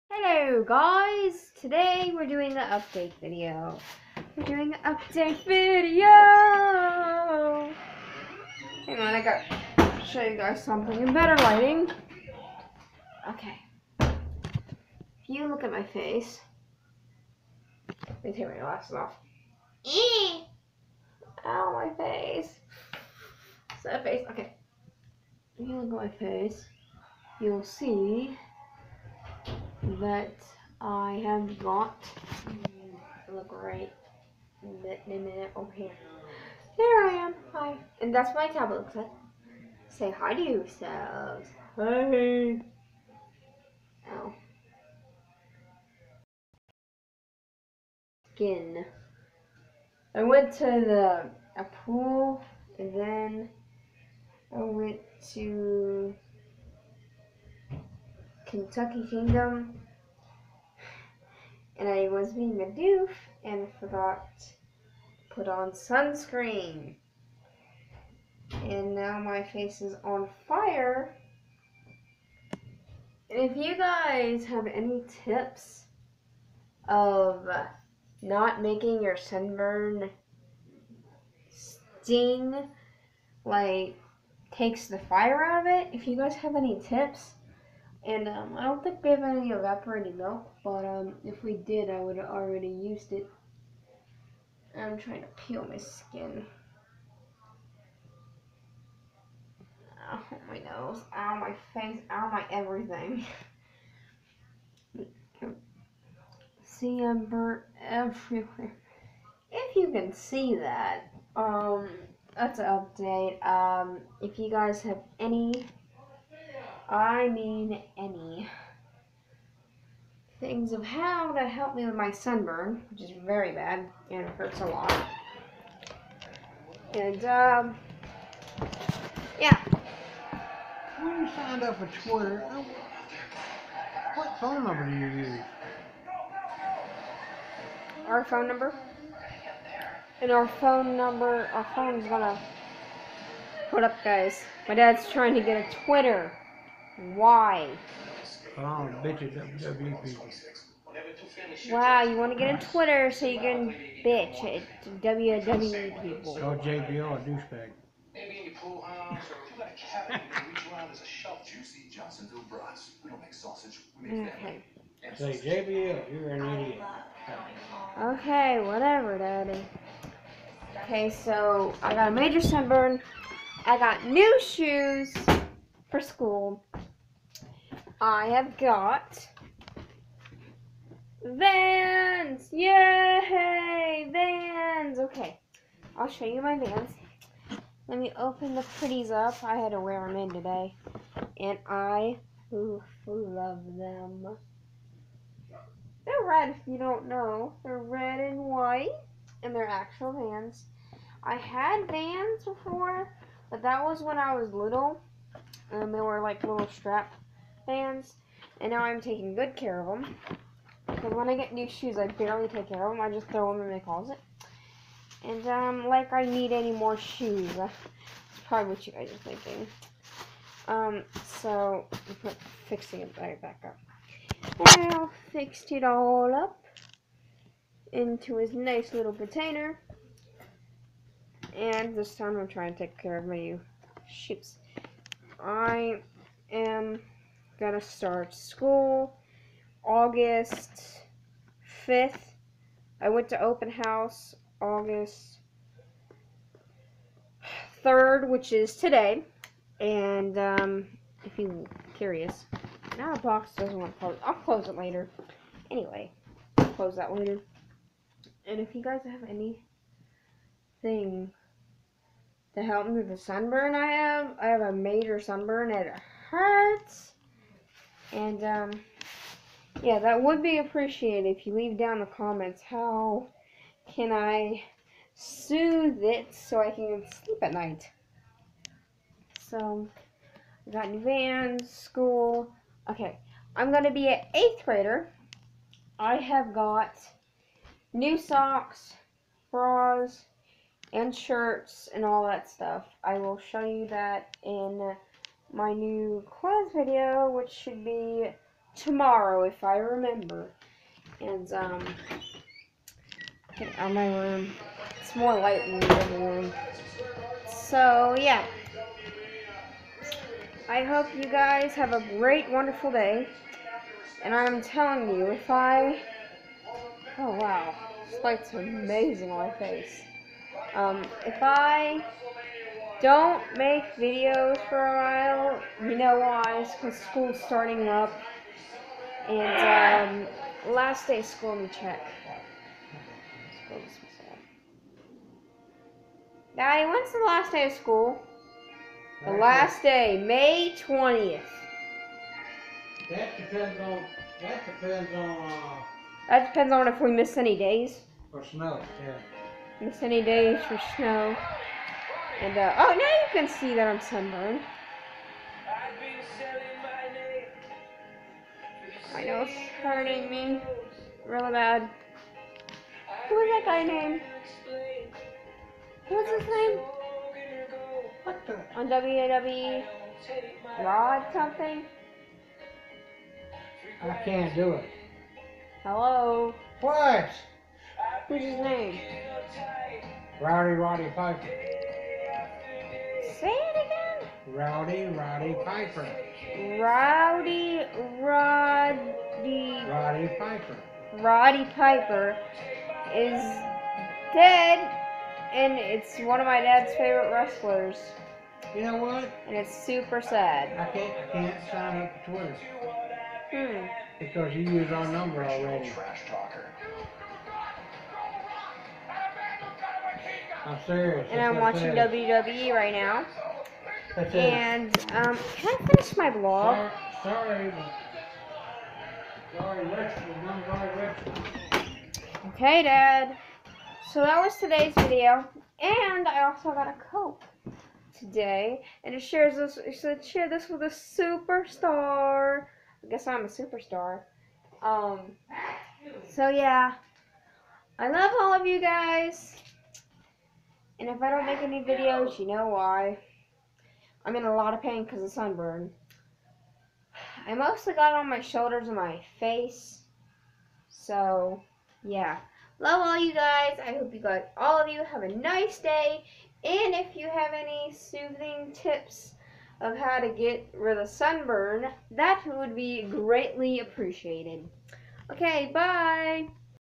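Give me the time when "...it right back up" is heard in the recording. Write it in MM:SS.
03:43.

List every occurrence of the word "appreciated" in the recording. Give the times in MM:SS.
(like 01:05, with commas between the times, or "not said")
04:30, 07:43.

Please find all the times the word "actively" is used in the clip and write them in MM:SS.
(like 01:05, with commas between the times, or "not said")
not said.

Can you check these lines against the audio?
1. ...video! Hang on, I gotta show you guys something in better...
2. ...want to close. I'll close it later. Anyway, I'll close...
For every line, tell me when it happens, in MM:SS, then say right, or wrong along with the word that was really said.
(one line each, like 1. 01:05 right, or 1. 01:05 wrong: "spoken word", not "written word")
1. 00:05 right
2. 04:13 right.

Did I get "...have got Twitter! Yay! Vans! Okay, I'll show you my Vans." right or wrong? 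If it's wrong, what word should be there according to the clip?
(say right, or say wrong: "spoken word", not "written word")
wrong: "Vans", not "Twitter".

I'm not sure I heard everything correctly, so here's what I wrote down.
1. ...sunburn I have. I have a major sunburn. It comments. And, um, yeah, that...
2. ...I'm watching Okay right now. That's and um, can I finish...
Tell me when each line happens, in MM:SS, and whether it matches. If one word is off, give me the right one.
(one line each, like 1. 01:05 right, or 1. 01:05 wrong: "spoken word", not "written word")
1. 04:23 wrong: "hurts", not "comments"
2. 06:51 wrong: "WWE", not "Okay".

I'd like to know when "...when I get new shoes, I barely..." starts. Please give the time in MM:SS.
03:31.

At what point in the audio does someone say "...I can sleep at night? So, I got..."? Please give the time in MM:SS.
04:36.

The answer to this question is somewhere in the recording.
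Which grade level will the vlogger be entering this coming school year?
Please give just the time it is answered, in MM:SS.
04:44.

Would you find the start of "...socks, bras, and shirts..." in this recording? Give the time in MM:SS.
04:48.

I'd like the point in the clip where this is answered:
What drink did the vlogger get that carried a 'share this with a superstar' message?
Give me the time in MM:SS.
07:07.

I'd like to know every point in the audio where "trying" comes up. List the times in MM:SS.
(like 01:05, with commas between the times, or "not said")
01:34, 02:25, 03:52.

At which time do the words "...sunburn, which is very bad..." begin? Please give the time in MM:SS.
02:02.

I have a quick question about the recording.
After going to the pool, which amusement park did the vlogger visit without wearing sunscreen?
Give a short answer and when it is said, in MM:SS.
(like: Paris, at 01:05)
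Kentucky Kingdom, at 00:58.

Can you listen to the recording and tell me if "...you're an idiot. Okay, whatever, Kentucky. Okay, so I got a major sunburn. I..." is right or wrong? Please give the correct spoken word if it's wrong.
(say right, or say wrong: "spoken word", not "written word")
wrong: "Daddy", not "Kentucky".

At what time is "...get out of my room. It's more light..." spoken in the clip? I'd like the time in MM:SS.
05:03.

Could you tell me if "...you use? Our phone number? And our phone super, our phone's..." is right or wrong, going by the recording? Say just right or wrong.
wrong.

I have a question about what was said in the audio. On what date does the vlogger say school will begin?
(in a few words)
August 5th.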